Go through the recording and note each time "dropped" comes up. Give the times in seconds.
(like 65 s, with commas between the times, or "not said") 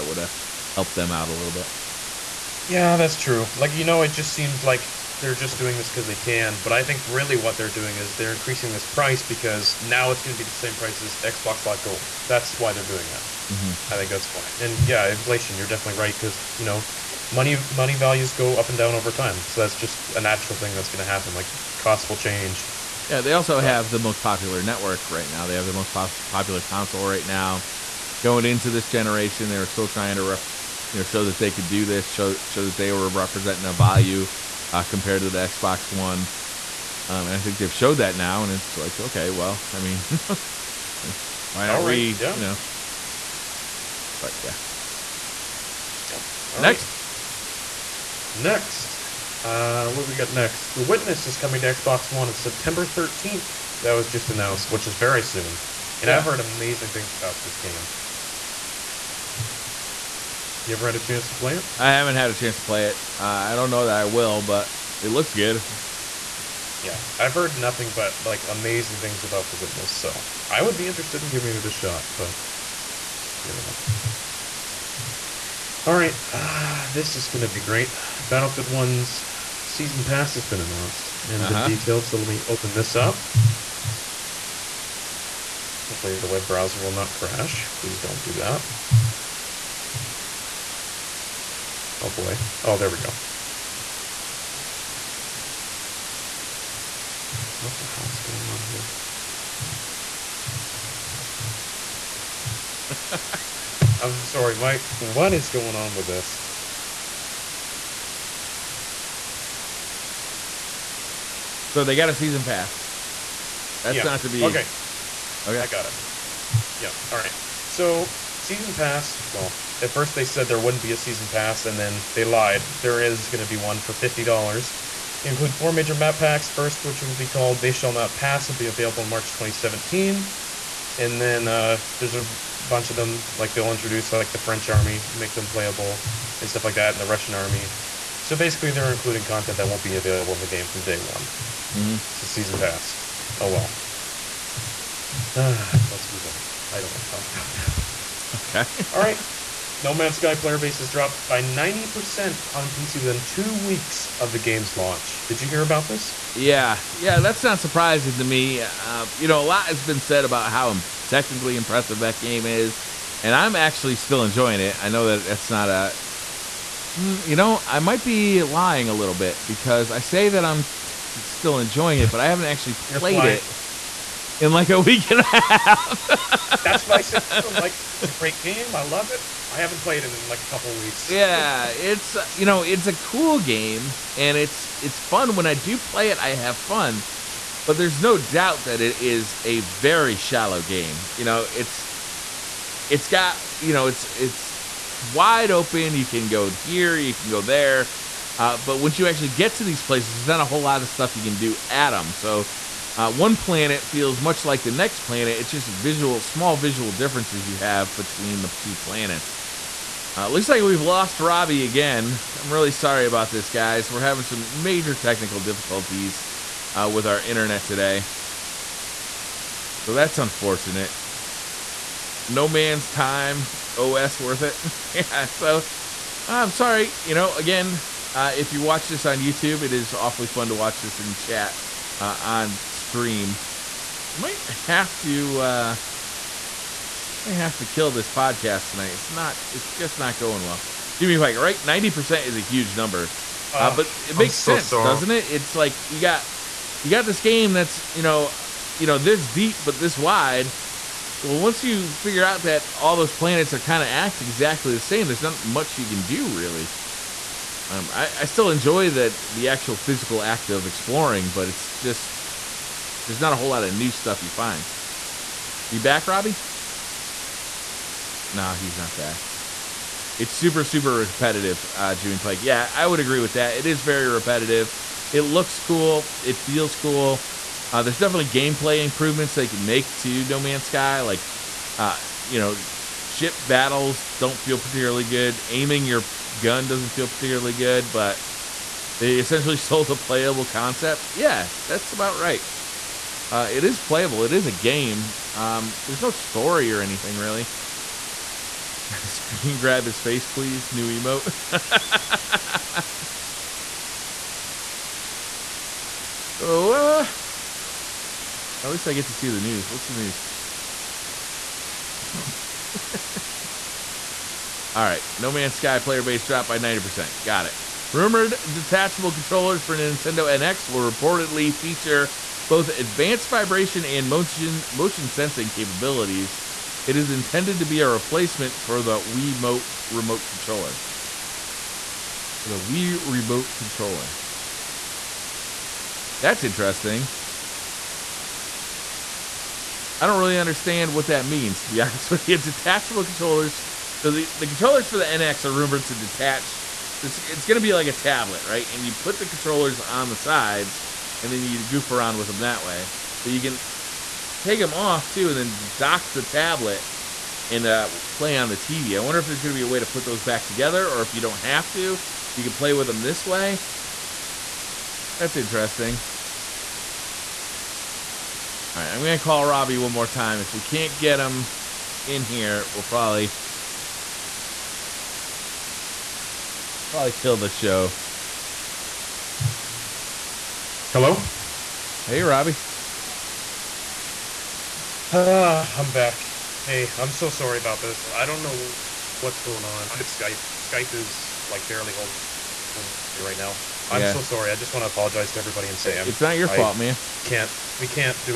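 150 s, 316 s.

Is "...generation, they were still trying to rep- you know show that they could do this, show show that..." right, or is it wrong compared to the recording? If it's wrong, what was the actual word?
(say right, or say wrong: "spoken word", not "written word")
right.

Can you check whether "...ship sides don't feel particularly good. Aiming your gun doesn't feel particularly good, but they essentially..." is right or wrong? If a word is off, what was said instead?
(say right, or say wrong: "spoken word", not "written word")
wrong: "battles", not "sides".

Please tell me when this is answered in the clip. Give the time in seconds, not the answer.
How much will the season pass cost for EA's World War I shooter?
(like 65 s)
123 s.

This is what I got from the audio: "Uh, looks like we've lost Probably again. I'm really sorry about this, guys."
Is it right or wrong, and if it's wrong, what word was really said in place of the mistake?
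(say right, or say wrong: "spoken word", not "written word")
wrong: "Robbie", not "Probably".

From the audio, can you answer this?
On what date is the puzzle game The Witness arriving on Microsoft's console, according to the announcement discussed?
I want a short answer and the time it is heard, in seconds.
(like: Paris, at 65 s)
September 13th, at 52 s.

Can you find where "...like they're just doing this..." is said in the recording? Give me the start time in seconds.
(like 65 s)
4 s.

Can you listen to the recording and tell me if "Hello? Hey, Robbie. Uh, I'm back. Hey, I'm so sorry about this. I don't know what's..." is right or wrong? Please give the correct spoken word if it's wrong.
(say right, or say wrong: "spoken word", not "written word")
right.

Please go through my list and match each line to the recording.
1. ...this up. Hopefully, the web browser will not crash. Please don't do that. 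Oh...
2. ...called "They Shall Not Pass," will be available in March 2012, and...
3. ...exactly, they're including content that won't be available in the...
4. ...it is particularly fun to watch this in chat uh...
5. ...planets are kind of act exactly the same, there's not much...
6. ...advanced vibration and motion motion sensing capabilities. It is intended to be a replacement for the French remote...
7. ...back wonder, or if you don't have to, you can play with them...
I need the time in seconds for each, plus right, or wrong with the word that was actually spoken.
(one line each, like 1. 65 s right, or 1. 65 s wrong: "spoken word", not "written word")
1. 82 s right
2. 127 s wrong: "2017", not "2012"
3. 138 s wrong: "basically", not "exactly"
4. 229 s wrong: "awfully", not "particularly"
5. 253 s right
6. 322 s wrong: "Wii", not "French"
7. 360 s wrong: "together", not "wonder".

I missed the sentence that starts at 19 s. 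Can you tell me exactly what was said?
So that's just a natural thing that's going to happen.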